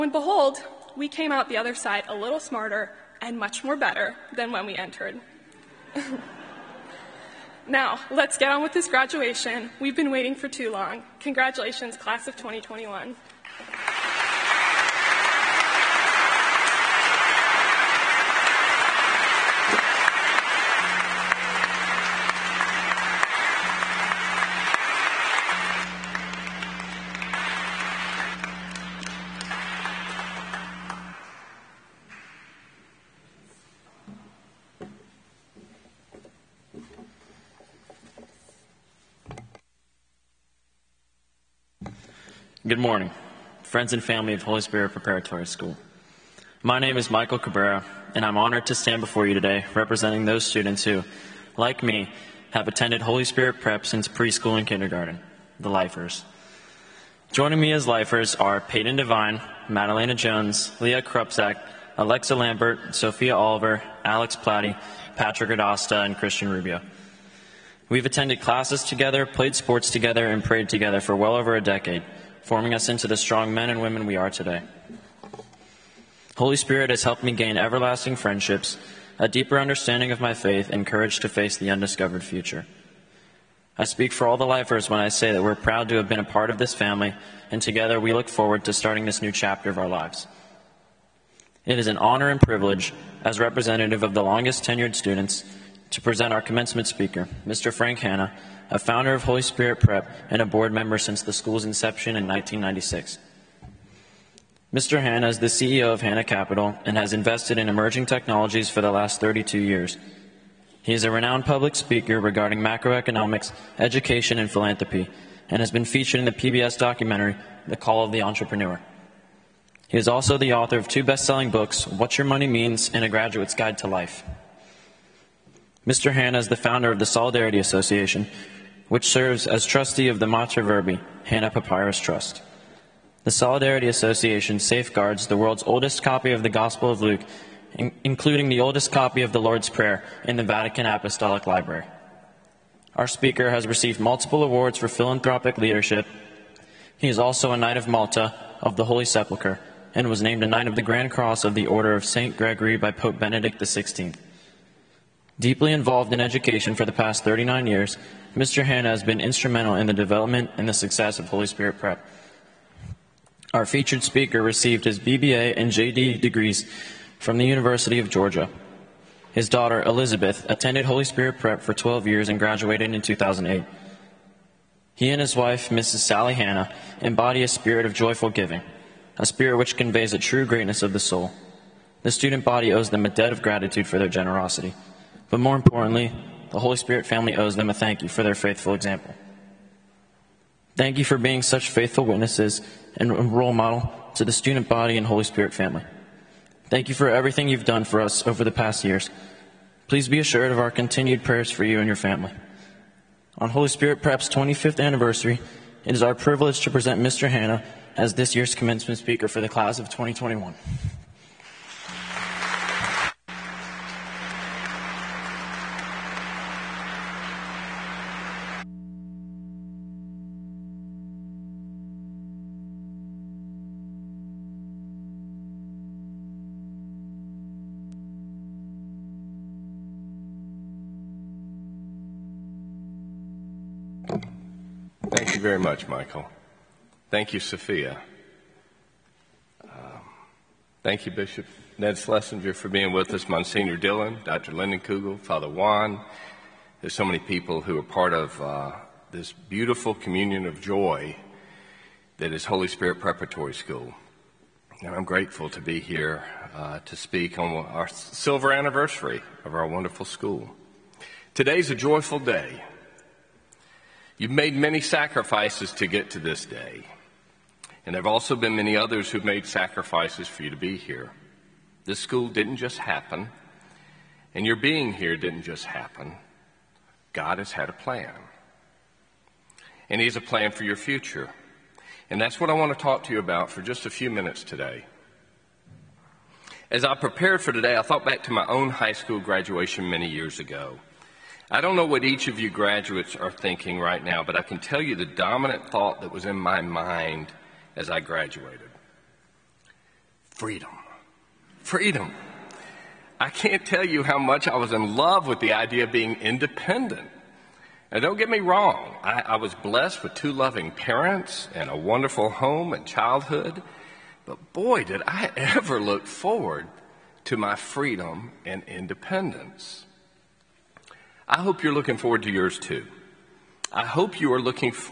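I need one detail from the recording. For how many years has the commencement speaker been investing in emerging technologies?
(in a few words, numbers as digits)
32.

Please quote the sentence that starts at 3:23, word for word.
On Holy Spirit Prep's 25th anniversary, it is our privilege to present Mr.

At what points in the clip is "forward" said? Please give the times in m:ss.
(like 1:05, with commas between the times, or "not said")
1:28, 5:16, 5:21.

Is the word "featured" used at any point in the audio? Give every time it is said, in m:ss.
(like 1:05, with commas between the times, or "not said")
1:55, 2:43.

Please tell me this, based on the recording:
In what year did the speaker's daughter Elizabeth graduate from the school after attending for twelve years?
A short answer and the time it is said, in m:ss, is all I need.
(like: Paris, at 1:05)
2008, at 2:53.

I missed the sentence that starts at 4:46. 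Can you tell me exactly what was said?
As I prepared for today, I thought back to my own high school graduation many years ago.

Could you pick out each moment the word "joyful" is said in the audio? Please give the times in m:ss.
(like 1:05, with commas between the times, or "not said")
2:57, 4:21.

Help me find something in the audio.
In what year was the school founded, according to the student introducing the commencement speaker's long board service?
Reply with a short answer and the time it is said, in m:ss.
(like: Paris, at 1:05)
1996, at 1:42.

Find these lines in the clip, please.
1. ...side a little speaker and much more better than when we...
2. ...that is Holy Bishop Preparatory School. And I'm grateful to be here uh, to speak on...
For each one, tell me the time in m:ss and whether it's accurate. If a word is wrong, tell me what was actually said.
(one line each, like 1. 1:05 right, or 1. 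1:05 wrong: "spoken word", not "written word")
1. 0:01 wrong: "smarter", not "speaker"
2. 4:12 wrong: "Spirit", not "Bishop".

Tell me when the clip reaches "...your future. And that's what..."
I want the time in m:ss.
4:40.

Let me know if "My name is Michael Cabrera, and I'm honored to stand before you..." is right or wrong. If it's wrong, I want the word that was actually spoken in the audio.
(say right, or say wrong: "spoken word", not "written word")
right.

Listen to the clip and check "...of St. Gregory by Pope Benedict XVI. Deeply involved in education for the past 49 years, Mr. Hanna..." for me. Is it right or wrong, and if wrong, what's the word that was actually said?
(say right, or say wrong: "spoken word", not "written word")
wrong: "39", not "49".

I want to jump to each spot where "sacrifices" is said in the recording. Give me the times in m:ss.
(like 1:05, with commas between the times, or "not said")
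4:24, 4:29.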